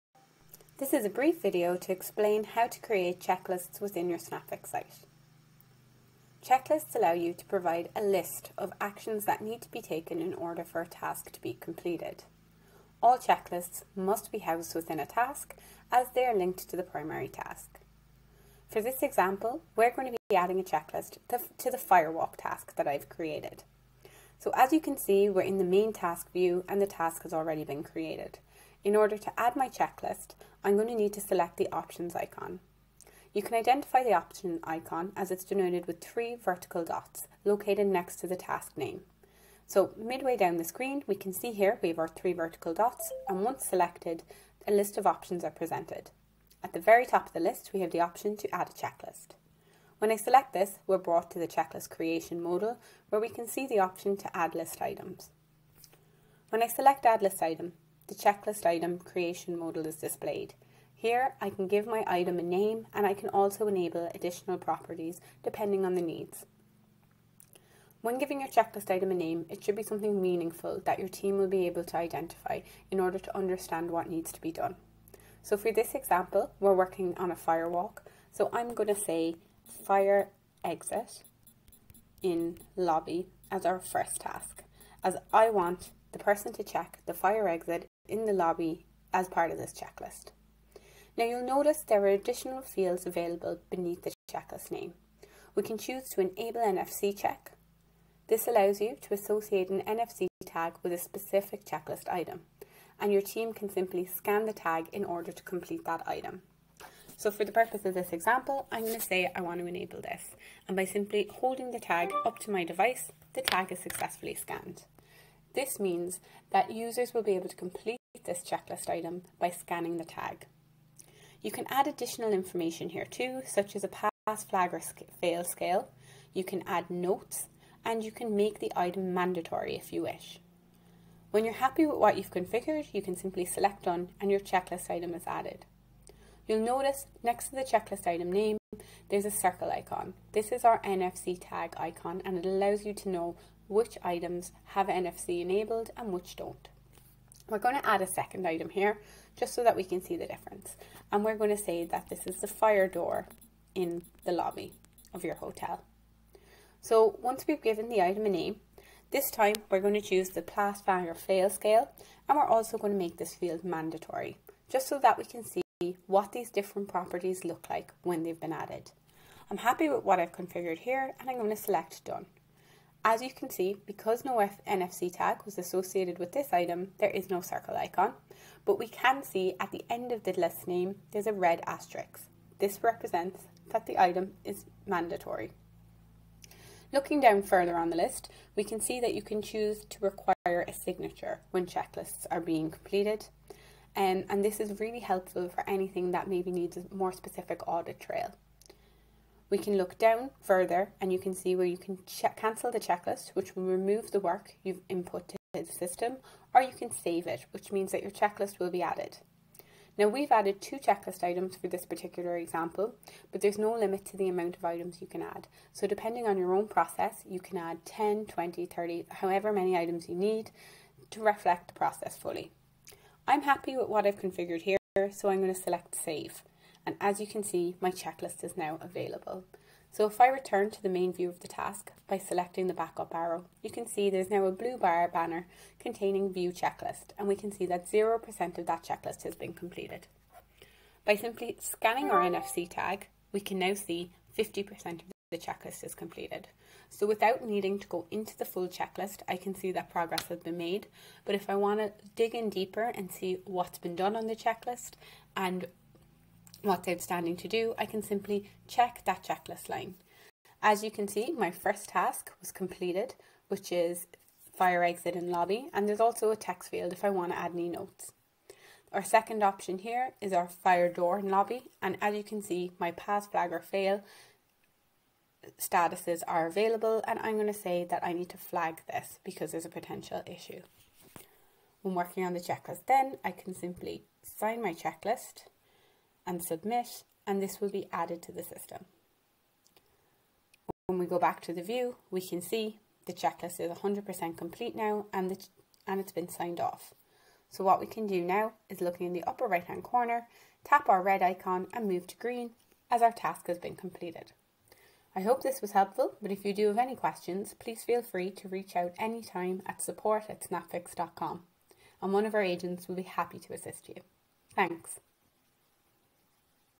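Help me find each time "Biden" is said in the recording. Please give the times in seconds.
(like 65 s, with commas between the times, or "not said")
not said.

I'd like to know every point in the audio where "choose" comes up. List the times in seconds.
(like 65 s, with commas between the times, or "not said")
95 s, 160 s, 189 s.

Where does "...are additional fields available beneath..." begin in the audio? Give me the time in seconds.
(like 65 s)
92 s.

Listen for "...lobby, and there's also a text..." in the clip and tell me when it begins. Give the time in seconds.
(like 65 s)
265 s.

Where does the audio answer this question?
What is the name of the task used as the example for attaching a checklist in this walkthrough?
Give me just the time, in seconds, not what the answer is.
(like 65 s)
21 s.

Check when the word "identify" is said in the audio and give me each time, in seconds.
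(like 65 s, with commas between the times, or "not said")
33 s, 71 s.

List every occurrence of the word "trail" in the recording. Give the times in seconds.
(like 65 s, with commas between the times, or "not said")
197 s.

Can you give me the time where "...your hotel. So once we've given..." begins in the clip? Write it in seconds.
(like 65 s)
155 s.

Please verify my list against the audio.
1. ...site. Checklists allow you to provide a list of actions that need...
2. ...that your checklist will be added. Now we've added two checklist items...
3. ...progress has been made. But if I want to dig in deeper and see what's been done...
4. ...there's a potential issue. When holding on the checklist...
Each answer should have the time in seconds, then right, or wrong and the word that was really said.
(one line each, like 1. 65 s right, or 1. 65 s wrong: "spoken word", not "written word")
1. 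4 s right
2. 207 s right
3. 249 s right
4. 279 s wrong: "working", not "holding".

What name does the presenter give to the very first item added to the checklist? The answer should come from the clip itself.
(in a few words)
Fire exit in lobby.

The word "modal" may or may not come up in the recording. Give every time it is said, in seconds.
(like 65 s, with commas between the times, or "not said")
52 s, 59 s.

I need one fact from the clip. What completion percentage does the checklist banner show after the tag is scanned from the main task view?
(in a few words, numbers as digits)
50%.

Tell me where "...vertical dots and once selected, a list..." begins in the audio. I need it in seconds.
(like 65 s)
42 s.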